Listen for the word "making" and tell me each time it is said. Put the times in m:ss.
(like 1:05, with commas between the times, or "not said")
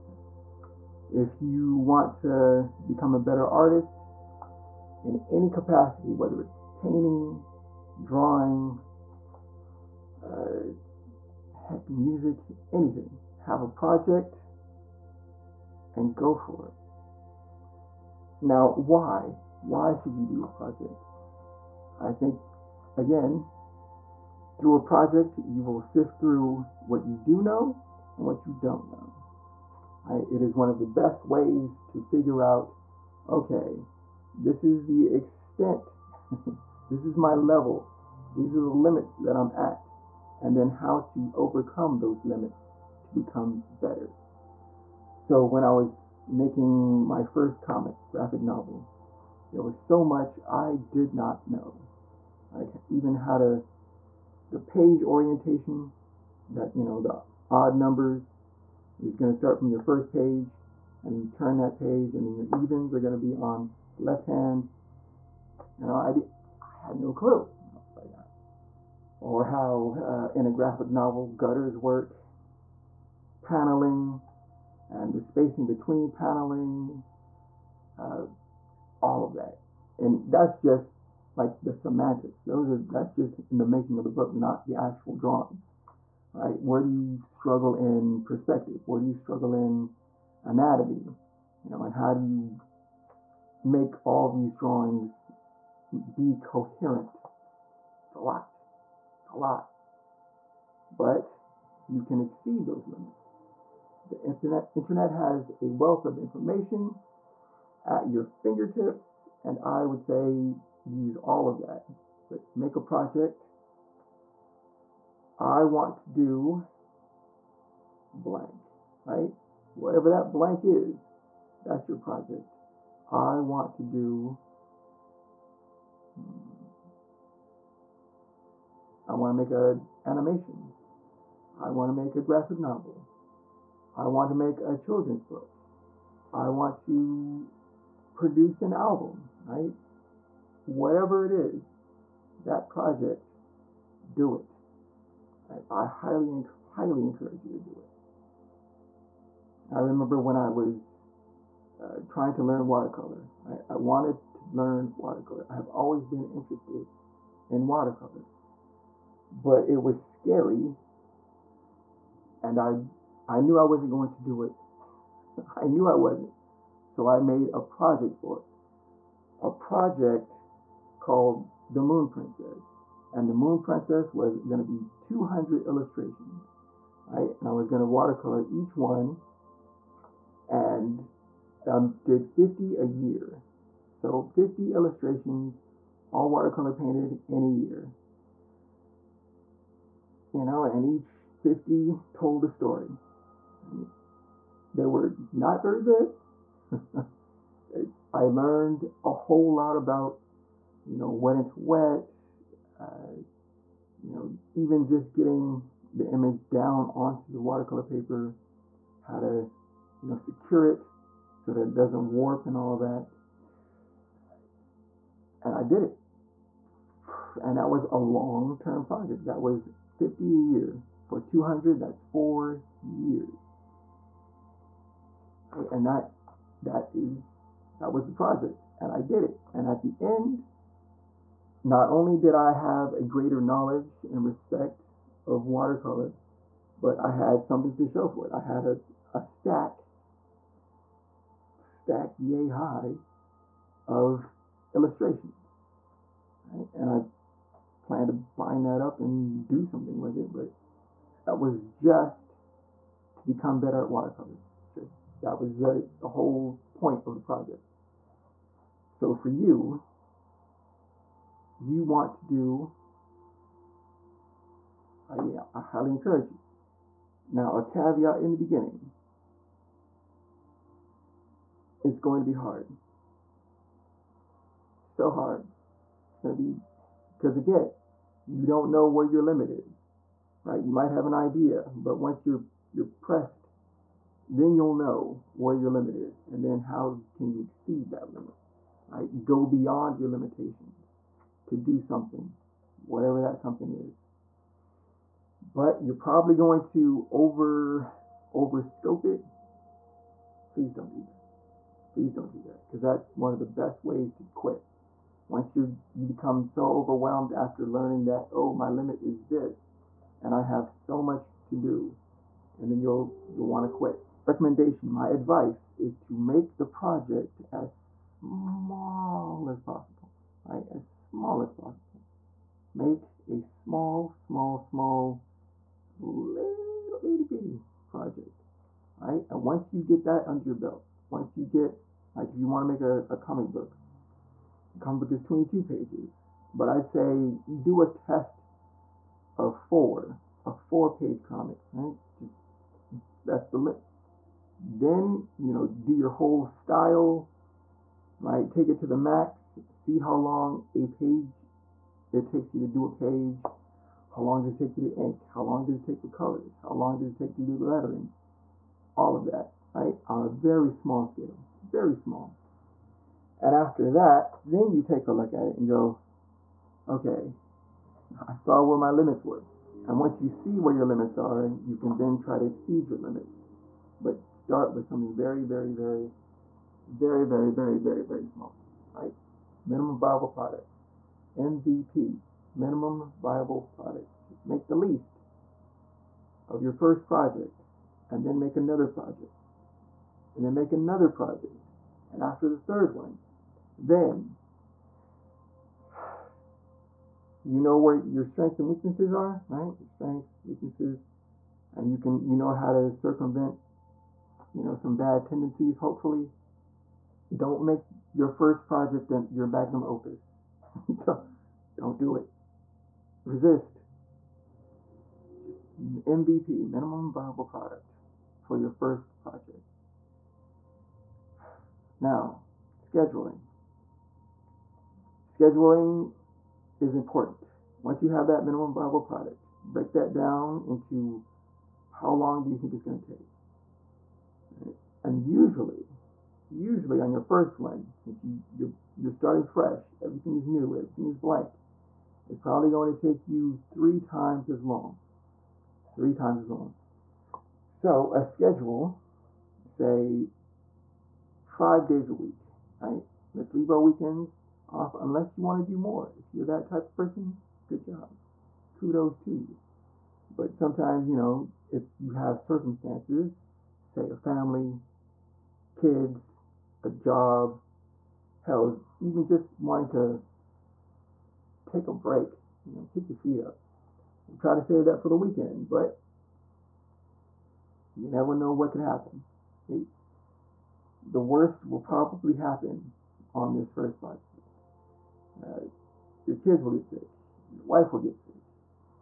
0:46, 1:23.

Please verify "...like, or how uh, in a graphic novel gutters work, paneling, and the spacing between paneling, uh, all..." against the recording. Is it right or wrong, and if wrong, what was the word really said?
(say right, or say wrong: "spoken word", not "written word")
right.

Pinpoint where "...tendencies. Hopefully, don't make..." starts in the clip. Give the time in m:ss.
6:45.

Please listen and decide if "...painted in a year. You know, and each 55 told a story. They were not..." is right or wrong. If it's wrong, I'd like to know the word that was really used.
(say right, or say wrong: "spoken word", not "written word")
wrong: "50", not "55".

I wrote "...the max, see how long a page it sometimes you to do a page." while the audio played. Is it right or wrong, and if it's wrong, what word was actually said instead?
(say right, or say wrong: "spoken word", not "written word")
wrong: "takes", not "sometimes".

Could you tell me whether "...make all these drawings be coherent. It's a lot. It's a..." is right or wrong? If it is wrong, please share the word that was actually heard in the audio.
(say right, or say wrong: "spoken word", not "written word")
right.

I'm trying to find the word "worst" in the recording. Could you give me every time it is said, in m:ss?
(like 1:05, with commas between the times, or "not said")
8:01.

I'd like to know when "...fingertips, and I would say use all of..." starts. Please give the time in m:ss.
1:48.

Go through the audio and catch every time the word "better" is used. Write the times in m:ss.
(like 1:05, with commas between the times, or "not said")
0:03, 0:43, 4:13.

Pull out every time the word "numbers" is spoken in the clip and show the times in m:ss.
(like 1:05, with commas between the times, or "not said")
0:57.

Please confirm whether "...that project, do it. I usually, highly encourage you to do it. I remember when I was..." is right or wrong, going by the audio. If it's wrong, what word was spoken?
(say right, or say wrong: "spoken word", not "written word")
wrong: "highly", not "usually".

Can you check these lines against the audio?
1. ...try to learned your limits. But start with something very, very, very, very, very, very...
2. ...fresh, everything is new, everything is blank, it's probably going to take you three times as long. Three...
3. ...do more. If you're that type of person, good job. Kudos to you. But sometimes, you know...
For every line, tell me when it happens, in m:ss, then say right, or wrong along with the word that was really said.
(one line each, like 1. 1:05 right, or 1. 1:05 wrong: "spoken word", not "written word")
1. 6:12 wrong: "exceed", not "learned"
2. 7:19 right
3. 7:35 right.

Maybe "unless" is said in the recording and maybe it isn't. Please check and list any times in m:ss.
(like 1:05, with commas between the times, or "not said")
7:34.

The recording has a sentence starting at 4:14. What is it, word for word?
Just that was the, the whole point of the project.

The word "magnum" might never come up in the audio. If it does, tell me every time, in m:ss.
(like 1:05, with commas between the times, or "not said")
6:49.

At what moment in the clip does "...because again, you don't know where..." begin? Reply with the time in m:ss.
4:37.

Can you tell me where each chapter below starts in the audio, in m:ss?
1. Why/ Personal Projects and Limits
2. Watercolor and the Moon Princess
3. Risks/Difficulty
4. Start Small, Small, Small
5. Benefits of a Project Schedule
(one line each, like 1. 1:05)
1. 0:22
2. 2:31
3. 4:32
4. 5:15
5. 7:02.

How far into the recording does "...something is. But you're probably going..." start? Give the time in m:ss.
4:53.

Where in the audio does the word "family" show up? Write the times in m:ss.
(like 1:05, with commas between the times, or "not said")
7:44.